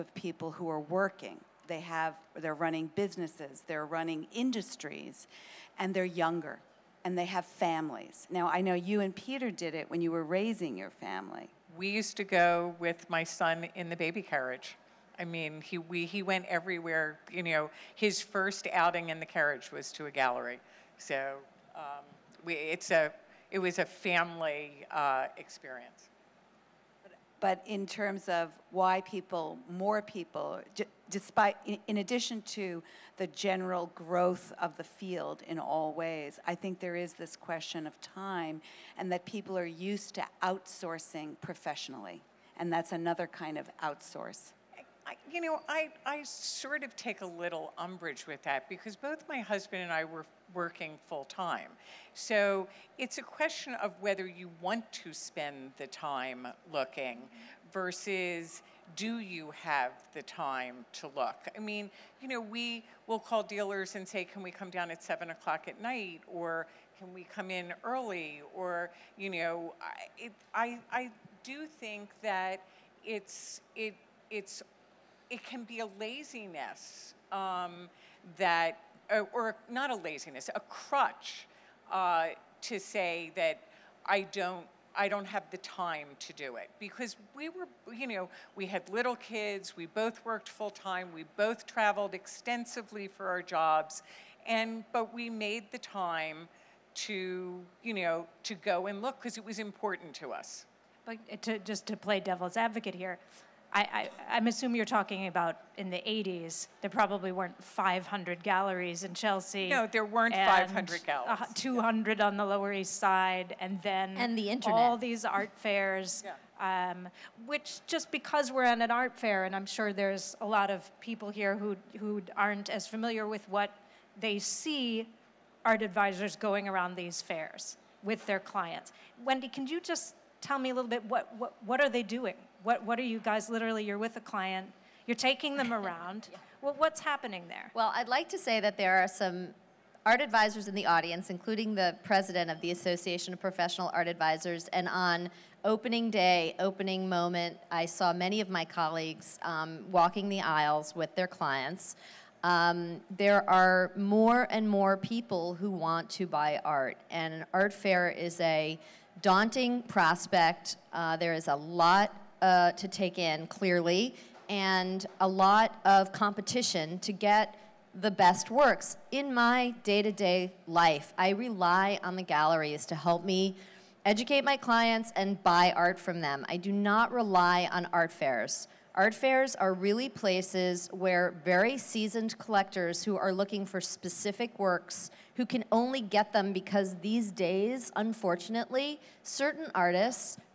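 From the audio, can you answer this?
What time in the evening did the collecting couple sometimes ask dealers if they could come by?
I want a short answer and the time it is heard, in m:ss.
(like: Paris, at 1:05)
7 o'clock, at 1:05.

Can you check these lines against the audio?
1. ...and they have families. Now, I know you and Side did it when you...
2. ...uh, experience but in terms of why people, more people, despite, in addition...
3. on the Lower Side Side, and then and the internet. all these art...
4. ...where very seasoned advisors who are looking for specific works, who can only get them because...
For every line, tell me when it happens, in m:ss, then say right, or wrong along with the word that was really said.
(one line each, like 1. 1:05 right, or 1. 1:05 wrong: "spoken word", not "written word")
1. 0:07 wrong: "Peter", not "Side"
2. 0:24 right
3. 1:52 wrong: "East", not "Side"
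4. 3:00 wrong: "collectors", not "advisors".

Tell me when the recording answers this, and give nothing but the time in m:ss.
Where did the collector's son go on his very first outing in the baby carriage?
0:20.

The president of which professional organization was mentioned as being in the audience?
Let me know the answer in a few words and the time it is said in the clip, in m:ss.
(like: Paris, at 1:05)
Association of Professional Art Advisors, at 2:22.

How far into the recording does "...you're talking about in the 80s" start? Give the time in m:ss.
1:44.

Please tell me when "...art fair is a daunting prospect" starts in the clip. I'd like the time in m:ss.
2:37.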